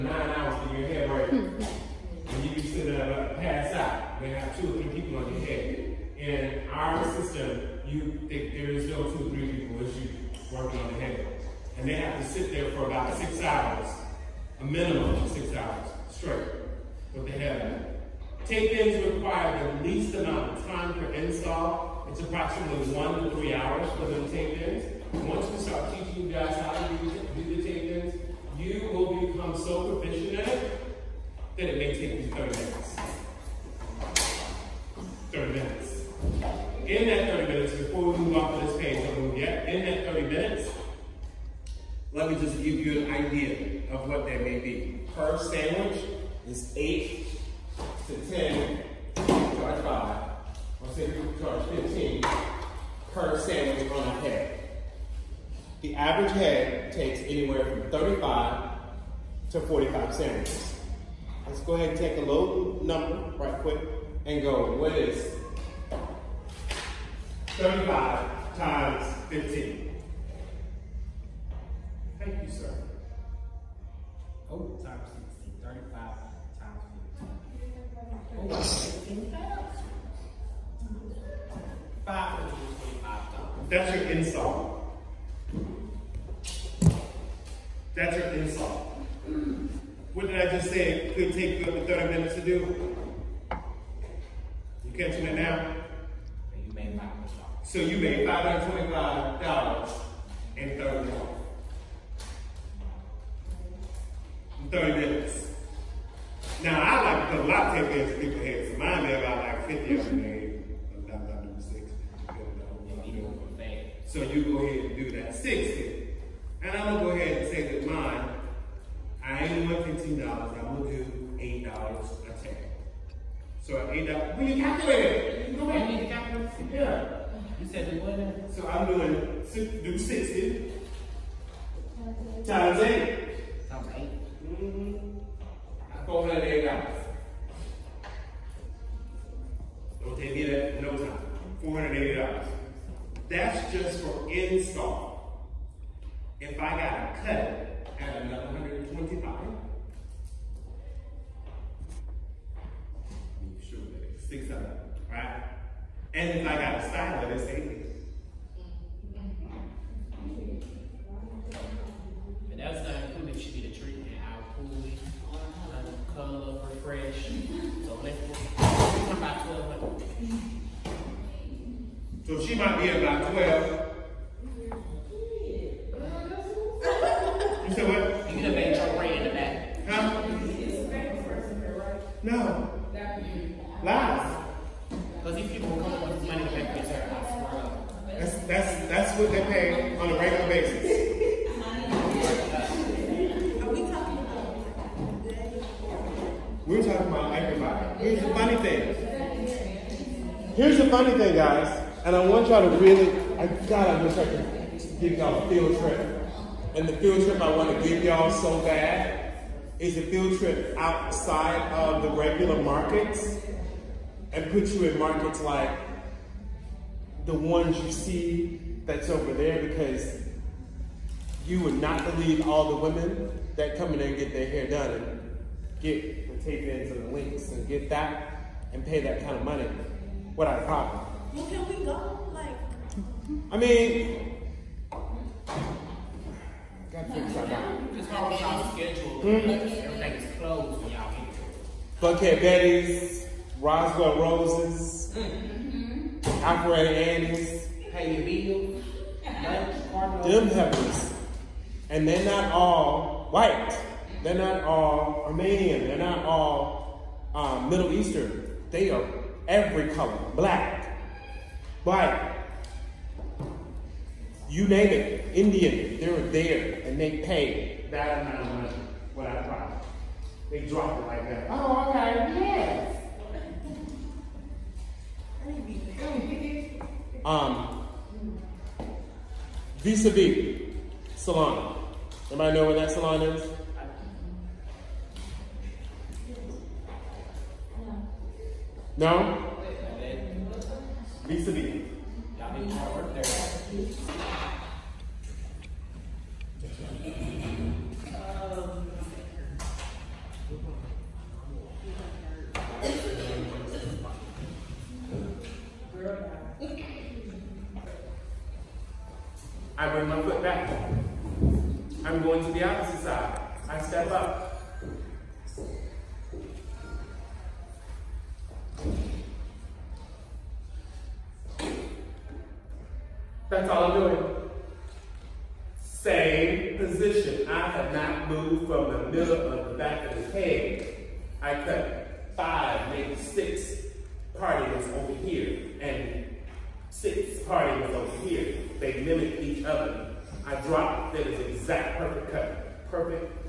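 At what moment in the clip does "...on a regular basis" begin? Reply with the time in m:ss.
3:09.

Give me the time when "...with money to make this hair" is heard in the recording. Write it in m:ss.
3:06.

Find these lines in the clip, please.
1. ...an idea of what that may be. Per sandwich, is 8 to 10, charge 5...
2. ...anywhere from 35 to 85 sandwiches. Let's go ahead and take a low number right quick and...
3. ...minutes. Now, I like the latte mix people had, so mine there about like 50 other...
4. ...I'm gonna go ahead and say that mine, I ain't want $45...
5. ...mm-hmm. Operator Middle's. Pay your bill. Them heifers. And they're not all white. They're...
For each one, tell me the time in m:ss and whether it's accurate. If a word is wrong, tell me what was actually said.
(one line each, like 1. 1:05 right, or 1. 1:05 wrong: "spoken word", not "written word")
1. 0:43 right
2. 0:57 wrong: "45", not "85"
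3. 1:44 right
4. 1:56 wrong: "15", not "45"
5. 4:05 wrong: "Annie", not "Middle".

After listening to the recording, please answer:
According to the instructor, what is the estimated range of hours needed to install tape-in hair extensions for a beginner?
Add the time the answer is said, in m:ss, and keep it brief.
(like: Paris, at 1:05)
1 to 3 hours, at 0:22.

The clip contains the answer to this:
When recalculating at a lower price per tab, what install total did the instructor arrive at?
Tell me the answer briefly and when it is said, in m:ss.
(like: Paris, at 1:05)
$480, at 2:21.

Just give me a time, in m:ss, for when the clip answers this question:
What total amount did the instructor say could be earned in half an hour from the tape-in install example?
1:38.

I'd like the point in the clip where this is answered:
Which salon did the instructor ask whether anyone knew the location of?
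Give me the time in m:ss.
4:39.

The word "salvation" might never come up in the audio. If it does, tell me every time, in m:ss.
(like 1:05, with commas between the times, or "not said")
not said.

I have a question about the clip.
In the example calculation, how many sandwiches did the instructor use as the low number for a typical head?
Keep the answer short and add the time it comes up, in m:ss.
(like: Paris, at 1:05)
35, at 1:07.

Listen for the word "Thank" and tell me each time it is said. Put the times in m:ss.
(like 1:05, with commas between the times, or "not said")
1:12.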